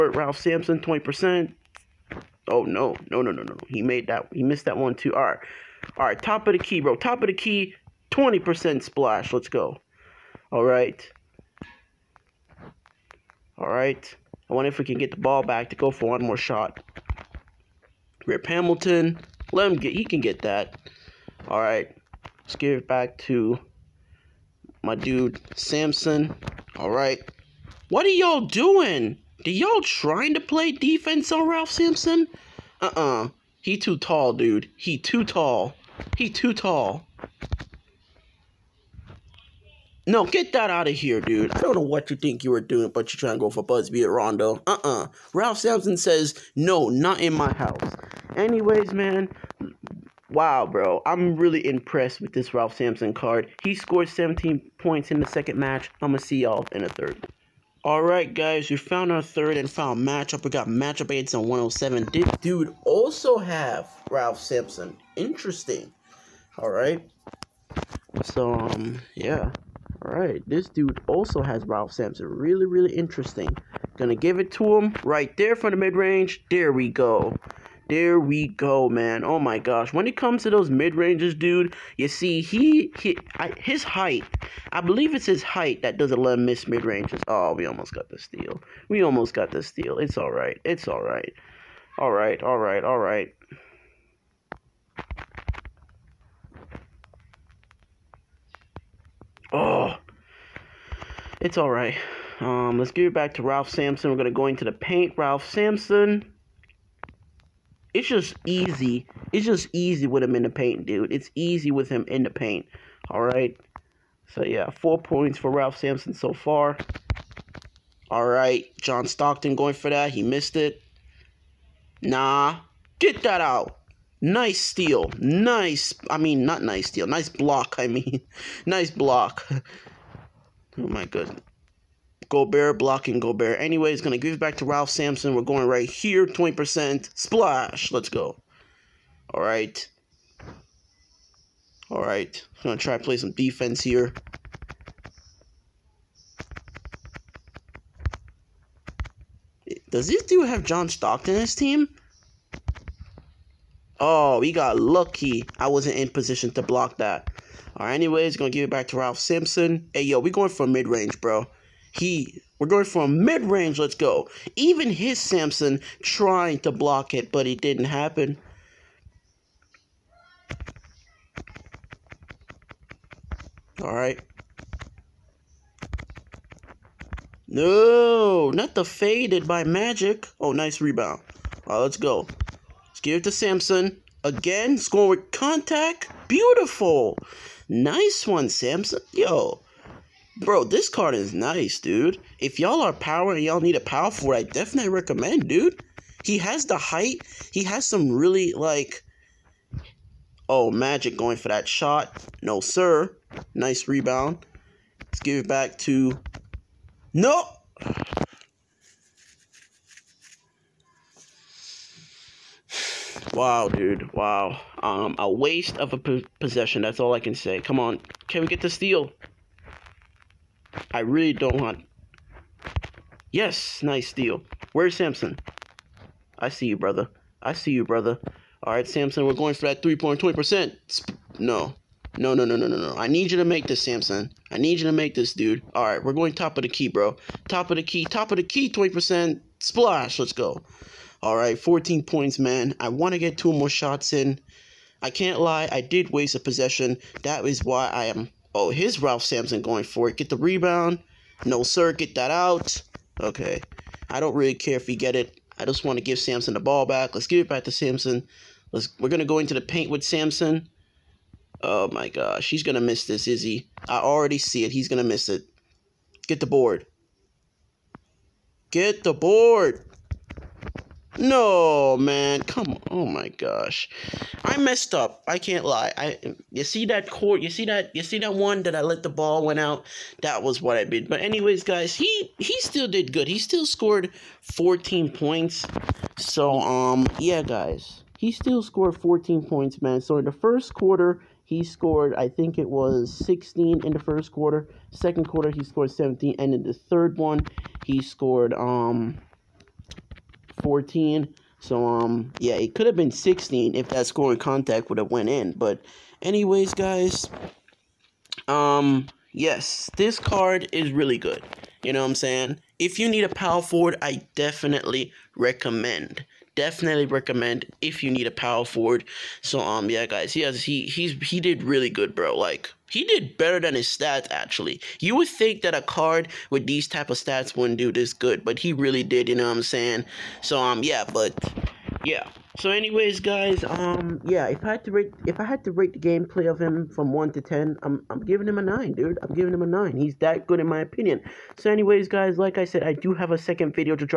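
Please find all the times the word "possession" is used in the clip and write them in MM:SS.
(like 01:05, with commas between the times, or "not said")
03:36, 04:06.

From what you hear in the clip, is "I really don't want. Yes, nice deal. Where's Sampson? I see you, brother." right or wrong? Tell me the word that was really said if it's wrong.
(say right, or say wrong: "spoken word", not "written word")
right.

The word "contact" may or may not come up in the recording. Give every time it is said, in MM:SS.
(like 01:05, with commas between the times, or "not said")
03:05, 05:04.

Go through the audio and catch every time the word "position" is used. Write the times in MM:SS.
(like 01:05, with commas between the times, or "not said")
02:36.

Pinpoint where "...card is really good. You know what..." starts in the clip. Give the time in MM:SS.
05:10.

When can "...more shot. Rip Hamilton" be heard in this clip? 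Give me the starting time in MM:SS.
00:16.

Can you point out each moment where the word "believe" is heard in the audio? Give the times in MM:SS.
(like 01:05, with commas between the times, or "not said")
01:24.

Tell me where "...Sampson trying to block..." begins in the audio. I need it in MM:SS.
02:45.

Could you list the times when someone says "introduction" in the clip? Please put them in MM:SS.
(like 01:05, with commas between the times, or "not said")
not said.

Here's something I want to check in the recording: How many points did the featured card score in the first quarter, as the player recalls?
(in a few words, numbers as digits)
16.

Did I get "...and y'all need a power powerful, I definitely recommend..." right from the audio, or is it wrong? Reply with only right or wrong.
right.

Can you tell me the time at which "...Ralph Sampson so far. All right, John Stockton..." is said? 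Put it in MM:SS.
01:55.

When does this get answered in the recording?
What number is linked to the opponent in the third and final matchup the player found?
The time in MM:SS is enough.
01:01.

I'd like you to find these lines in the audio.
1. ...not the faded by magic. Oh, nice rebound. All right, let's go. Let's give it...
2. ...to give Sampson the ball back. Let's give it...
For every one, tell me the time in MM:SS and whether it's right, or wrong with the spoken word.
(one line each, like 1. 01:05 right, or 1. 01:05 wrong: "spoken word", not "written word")
1. 02:58 right
2. 04:15 right.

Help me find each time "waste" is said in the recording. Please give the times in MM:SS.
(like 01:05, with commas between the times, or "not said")
03:35, 04:06.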